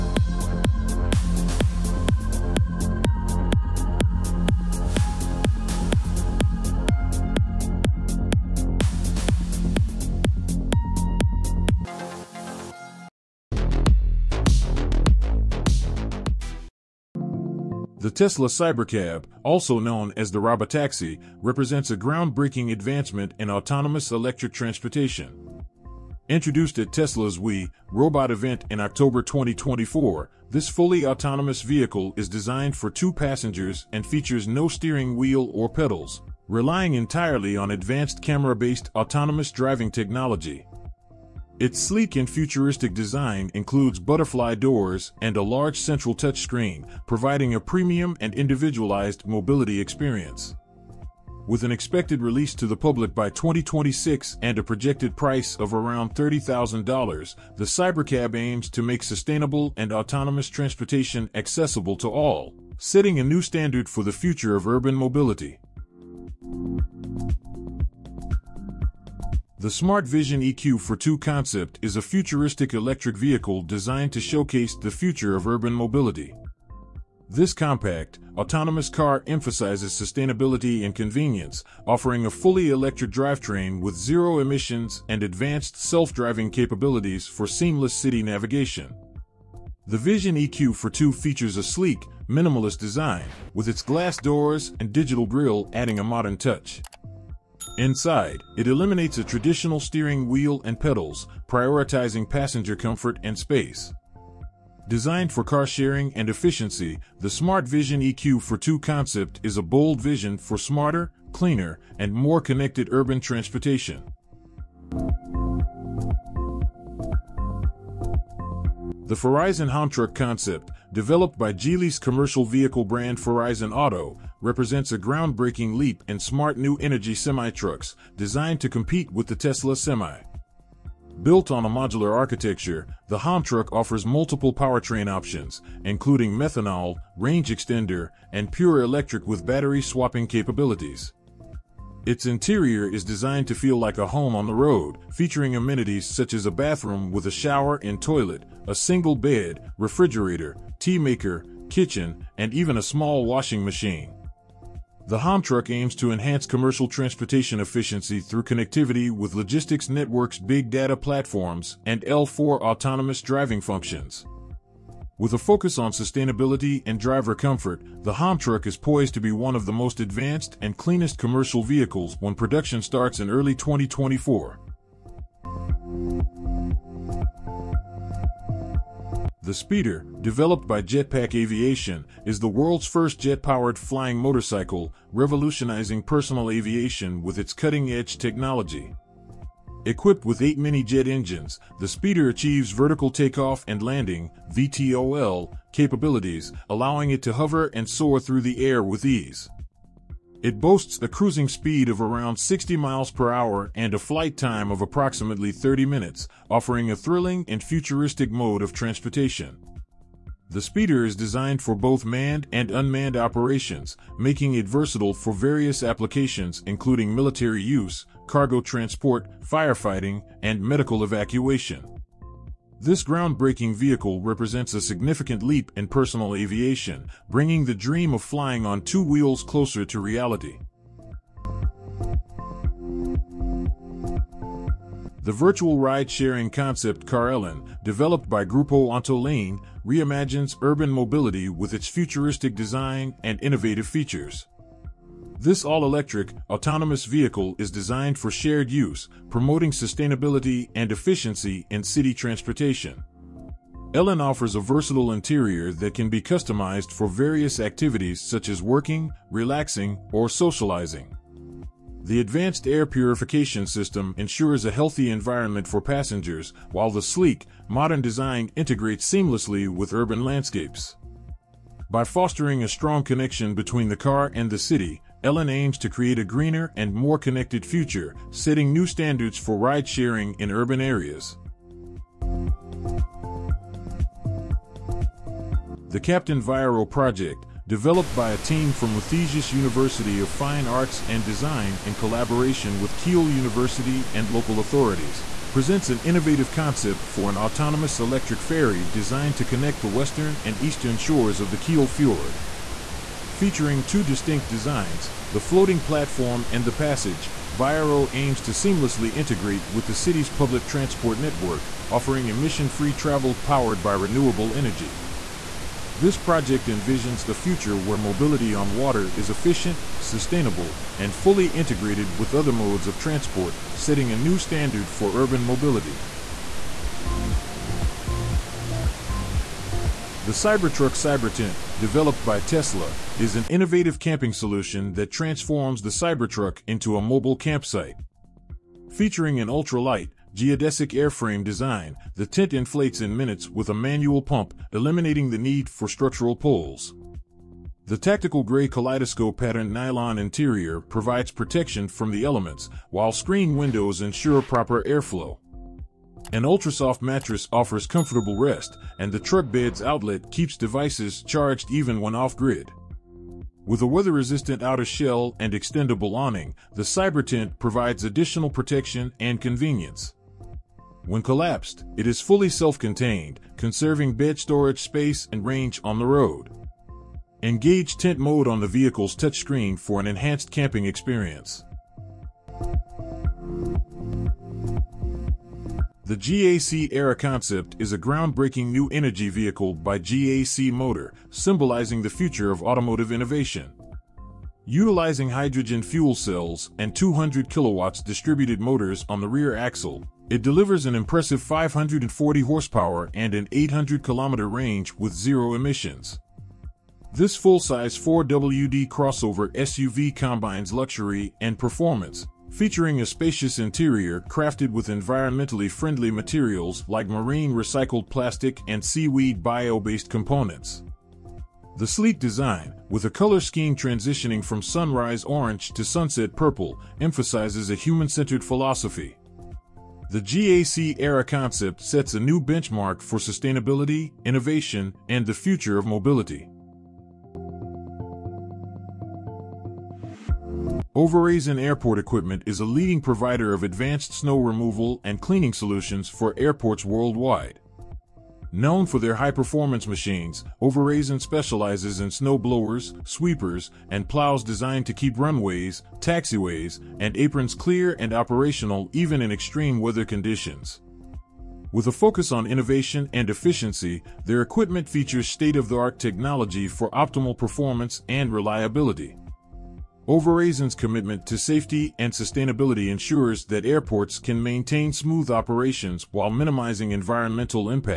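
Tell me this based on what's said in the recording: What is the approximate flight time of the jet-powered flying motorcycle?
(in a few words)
30 minutes.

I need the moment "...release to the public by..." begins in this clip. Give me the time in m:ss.
0:52.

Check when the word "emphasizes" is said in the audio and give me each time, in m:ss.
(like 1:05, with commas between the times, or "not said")
1:19, 7:07.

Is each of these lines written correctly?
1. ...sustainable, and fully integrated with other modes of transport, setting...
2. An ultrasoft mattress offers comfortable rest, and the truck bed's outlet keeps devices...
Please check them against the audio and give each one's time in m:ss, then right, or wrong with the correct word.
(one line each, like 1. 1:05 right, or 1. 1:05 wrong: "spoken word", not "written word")
1. 5:19 right
2. 5:56 right.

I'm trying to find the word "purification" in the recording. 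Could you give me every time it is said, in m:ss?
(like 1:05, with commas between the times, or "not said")
4:22.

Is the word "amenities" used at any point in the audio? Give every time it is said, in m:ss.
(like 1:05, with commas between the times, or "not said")
2:25.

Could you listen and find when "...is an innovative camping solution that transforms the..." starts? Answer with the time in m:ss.
5:33.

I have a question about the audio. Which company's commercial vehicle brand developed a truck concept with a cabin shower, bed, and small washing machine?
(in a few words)
Geely.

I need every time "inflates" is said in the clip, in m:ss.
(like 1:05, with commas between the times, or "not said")
5:42.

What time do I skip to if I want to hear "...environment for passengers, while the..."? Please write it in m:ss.
4:25.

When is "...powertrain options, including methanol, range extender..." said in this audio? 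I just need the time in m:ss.
2:14.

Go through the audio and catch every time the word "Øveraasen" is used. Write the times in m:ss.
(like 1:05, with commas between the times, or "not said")
7:20, 7:30, 7:50.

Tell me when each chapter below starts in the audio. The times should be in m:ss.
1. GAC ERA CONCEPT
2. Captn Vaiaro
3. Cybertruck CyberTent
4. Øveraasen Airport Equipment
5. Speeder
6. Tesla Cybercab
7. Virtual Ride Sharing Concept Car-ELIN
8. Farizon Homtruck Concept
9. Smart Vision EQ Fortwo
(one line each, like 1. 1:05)
1. 6:26
2. 4:46
3. 5:30
4. 7:21
5. 2:59
6. 0:18
7. 3:55
8. 1:59
9. 1:09.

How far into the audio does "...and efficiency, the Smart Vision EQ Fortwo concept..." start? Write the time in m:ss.
1:46.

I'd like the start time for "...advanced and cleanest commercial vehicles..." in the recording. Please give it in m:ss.
2:49.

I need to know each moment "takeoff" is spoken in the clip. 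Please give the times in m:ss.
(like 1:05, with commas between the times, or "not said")
3:13.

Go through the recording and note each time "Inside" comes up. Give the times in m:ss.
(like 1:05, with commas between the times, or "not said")
1:37.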